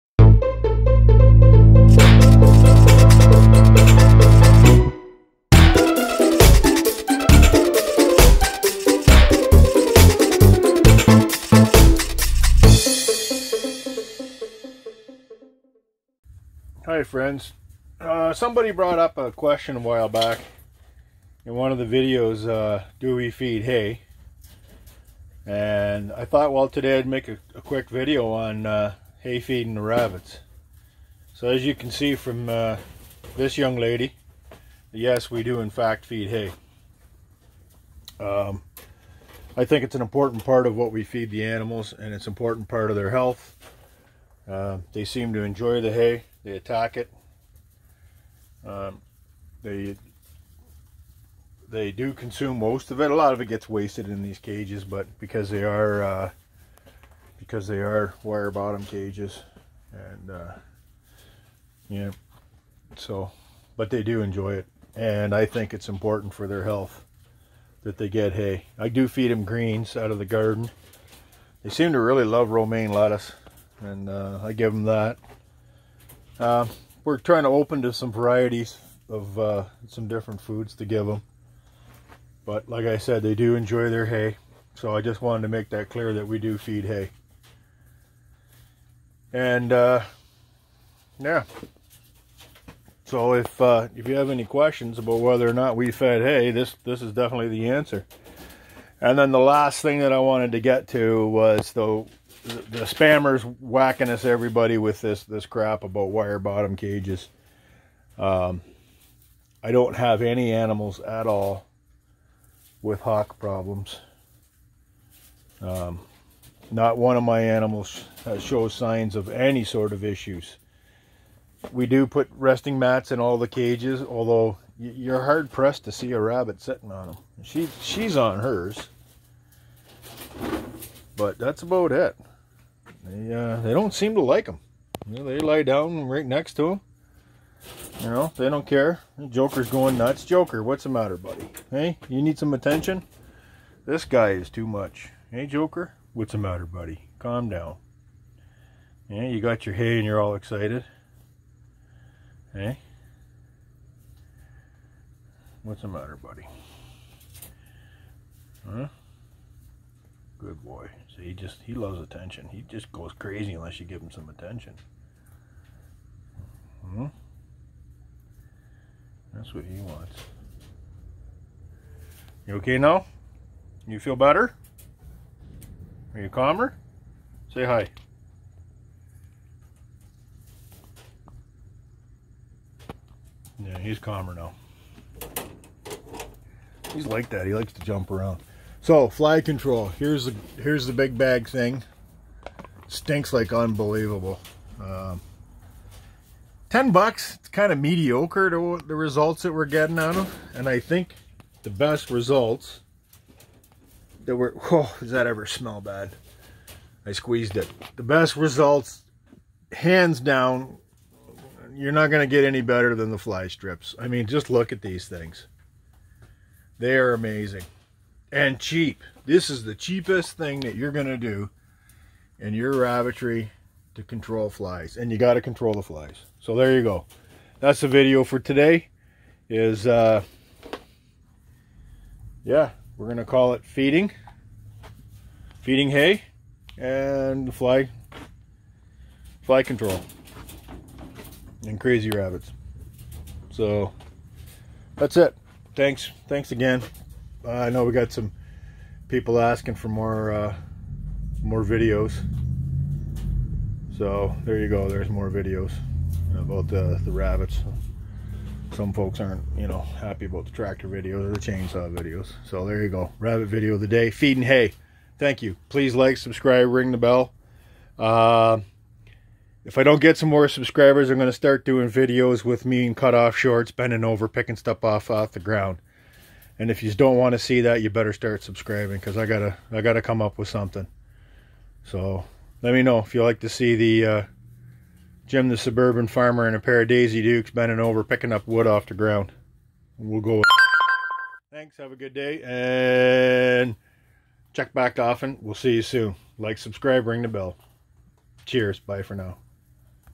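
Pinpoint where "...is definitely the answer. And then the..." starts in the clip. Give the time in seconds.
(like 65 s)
97 s.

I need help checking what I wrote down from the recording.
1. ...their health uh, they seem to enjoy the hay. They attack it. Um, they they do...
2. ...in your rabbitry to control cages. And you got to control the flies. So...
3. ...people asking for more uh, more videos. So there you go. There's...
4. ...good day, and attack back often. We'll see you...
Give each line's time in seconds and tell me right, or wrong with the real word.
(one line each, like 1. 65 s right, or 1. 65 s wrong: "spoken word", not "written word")
1. 42 s right
2. 222 s wrong: "flies", not "cages"
3. 249 s right
4. 291 s wrong: "check", not "attack".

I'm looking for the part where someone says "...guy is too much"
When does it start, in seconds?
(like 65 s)
144 s.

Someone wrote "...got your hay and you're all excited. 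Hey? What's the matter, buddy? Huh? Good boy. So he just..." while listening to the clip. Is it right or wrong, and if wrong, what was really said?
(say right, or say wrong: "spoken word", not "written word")
right.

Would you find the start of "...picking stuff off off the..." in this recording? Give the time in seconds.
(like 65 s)
274 s.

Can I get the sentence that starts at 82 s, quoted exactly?
But like I said, they do enjoy their hay.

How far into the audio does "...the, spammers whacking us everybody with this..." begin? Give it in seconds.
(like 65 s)
102 s.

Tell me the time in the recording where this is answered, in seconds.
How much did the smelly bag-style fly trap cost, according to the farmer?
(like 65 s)
196 s.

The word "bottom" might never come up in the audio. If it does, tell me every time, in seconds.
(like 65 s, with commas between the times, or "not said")
58 s, 106 s.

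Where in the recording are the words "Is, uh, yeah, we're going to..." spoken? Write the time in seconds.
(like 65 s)
229 s.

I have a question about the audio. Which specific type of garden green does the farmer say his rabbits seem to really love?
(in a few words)
romaine lettuce.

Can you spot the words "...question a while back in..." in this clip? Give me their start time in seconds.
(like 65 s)
19 s.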